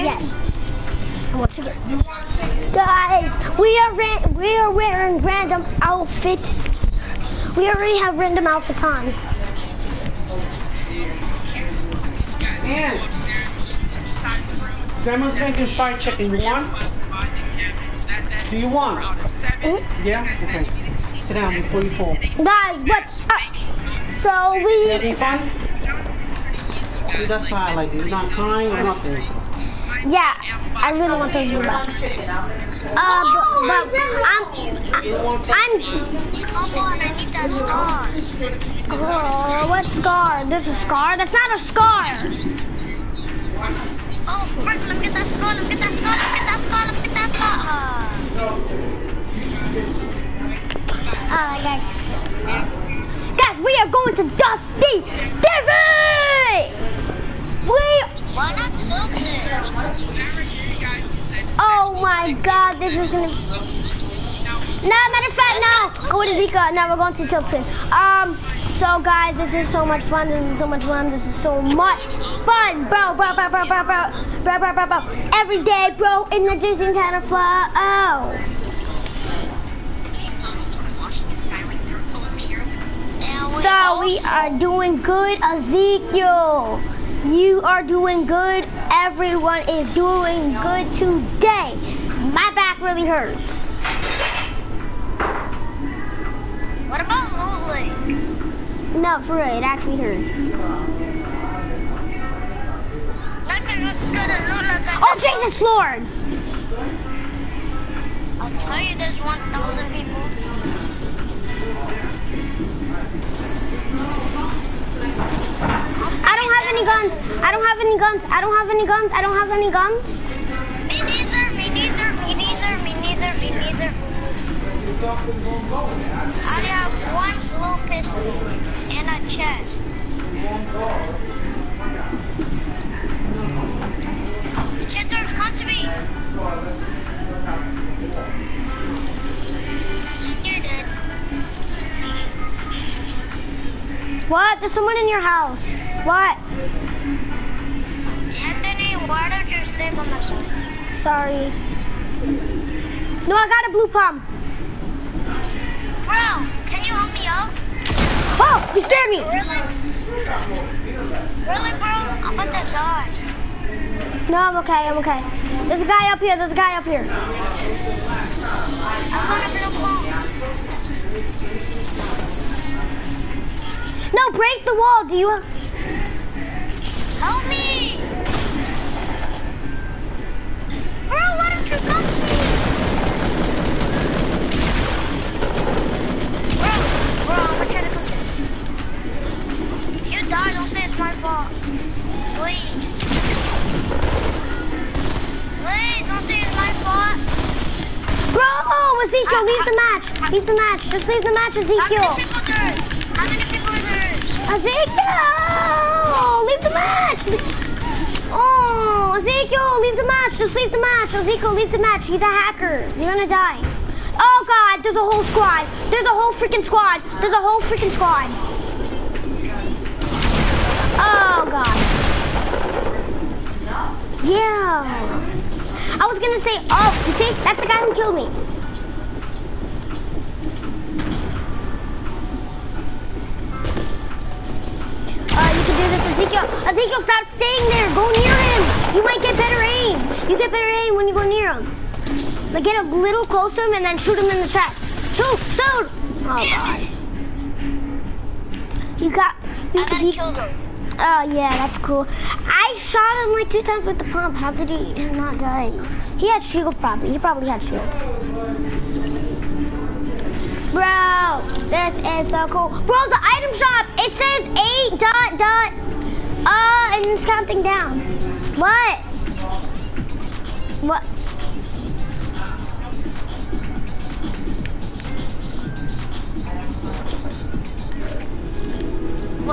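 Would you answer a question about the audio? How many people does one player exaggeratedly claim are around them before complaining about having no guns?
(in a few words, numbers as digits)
1,000.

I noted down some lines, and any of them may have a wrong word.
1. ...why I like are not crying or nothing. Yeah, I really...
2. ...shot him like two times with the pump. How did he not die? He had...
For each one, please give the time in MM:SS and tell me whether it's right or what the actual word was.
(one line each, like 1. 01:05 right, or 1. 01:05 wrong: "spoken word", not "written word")
1. 00:27 right
2. 04:12 right.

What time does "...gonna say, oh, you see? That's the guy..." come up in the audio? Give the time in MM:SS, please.
03:46.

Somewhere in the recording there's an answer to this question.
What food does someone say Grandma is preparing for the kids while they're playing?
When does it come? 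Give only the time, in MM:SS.
00:15.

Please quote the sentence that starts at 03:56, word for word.
think you'll, I think you'll stop staying there.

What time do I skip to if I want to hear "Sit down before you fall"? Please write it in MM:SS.
00:21.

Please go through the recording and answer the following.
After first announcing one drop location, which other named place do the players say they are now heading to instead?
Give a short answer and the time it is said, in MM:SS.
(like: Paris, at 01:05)
Tilton, at 01:07.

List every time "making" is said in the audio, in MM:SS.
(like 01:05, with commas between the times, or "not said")
00:15.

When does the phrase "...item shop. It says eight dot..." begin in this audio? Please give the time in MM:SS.
04:23.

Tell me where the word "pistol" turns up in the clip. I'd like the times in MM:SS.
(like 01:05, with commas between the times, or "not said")
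02:07.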